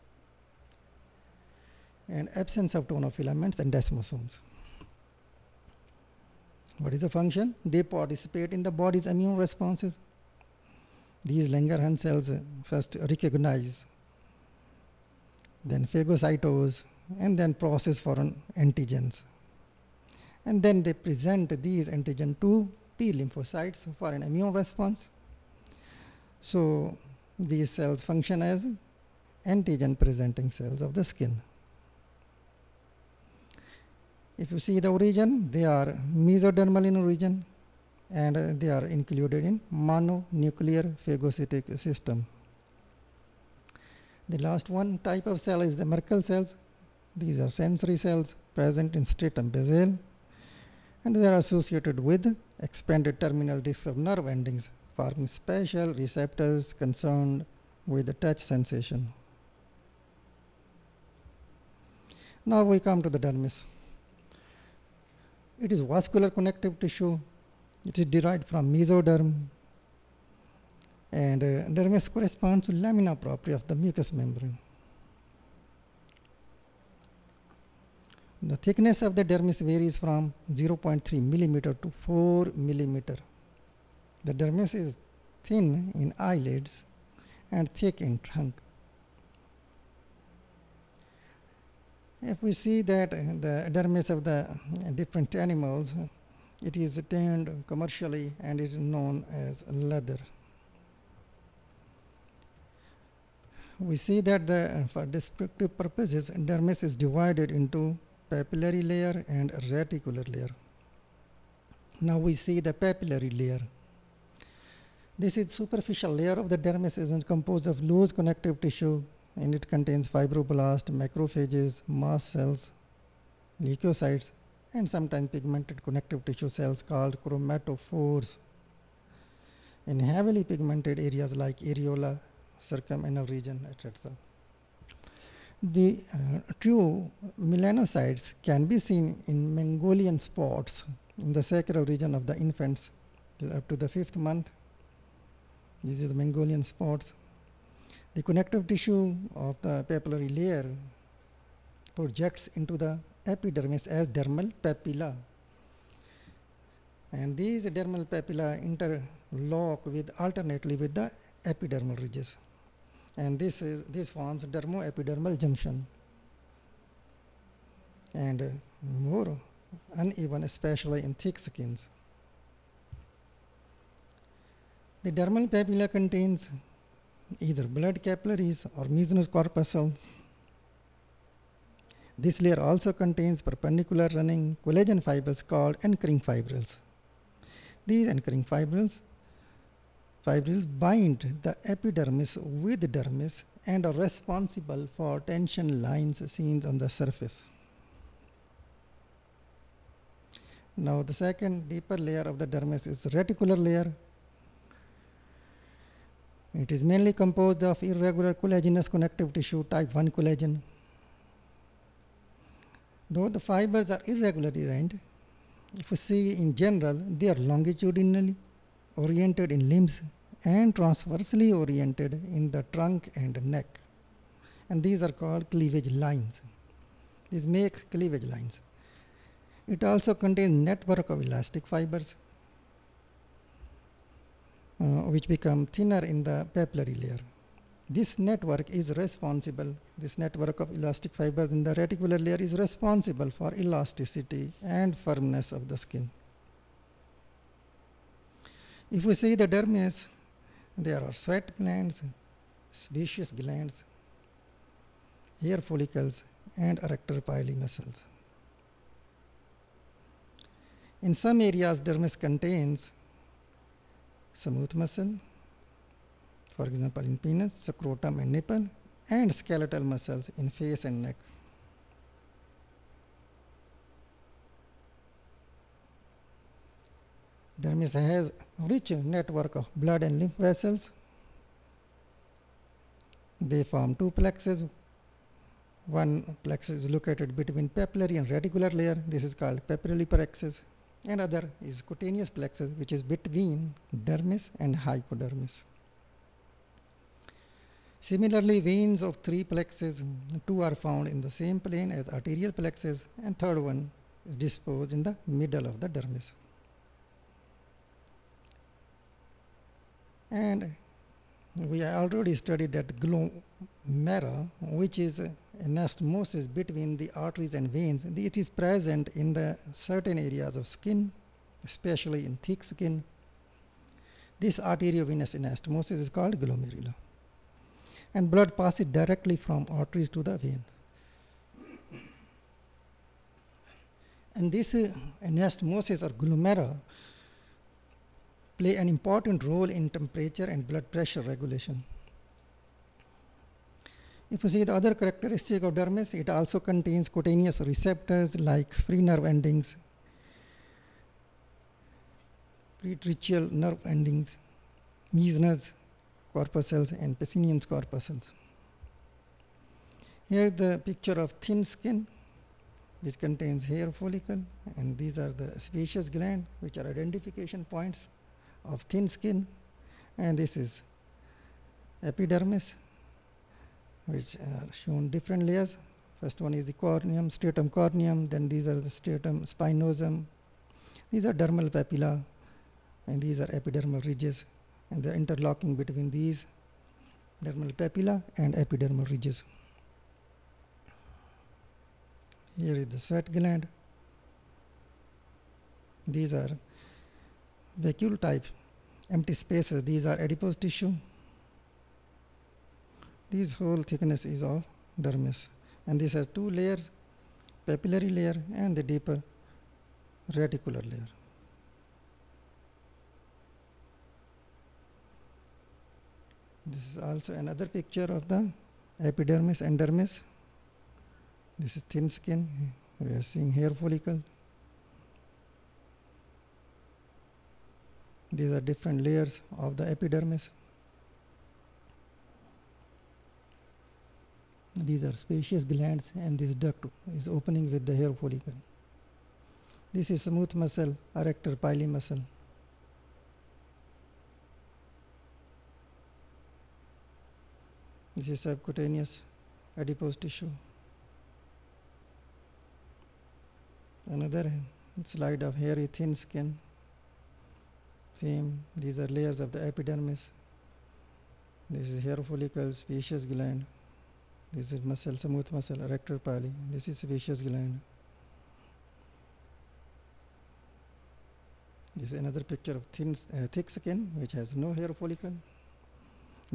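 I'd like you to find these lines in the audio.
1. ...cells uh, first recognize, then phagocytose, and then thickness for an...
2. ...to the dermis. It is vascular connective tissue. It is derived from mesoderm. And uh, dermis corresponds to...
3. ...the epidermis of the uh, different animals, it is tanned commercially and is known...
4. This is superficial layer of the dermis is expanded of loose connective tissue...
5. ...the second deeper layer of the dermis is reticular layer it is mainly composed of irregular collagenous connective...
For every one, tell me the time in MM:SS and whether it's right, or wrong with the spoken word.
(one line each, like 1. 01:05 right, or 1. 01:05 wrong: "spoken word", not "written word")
1. 00:11 wrong: "process", not "thickness"
2. 01:03 right
3. 01:33 wrong: "dermis", not "epidermis"
4. 01:55 wrong: "composed", not "expanded"
5. 03:21 right.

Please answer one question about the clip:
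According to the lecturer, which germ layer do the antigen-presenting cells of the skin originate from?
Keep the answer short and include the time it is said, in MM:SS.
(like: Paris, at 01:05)
Mesodermal, at 00:36.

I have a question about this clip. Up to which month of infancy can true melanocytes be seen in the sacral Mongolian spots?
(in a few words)
Fifth month.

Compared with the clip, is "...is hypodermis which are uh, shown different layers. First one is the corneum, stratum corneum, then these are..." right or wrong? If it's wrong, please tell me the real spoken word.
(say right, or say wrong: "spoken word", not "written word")
wrong: "epidermis", not "hypodermis".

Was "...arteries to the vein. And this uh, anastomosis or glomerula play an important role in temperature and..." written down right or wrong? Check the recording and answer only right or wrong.
right.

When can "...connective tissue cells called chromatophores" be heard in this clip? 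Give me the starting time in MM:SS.
02:05.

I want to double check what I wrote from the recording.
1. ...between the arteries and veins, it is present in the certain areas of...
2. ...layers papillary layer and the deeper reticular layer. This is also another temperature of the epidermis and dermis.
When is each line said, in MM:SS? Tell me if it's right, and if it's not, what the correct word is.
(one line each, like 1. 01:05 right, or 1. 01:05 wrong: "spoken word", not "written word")
1. 05:16 right
2. 06:46 wrong: "picture", not "temperature".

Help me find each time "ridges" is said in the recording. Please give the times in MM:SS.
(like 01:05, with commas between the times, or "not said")
02:42, 06:24, 06:29.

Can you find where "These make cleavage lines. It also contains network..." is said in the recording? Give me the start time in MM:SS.
03:47.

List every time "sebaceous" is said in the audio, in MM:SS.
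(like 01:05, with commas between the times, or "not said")
04:12, 06:05, 07:15, 07:42, 07:46.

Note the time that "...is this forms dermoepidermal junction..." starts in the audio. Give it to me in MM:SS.
02:43.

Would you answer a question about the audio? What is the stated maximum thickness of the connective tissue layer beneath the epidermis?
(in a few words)
4 millimeter.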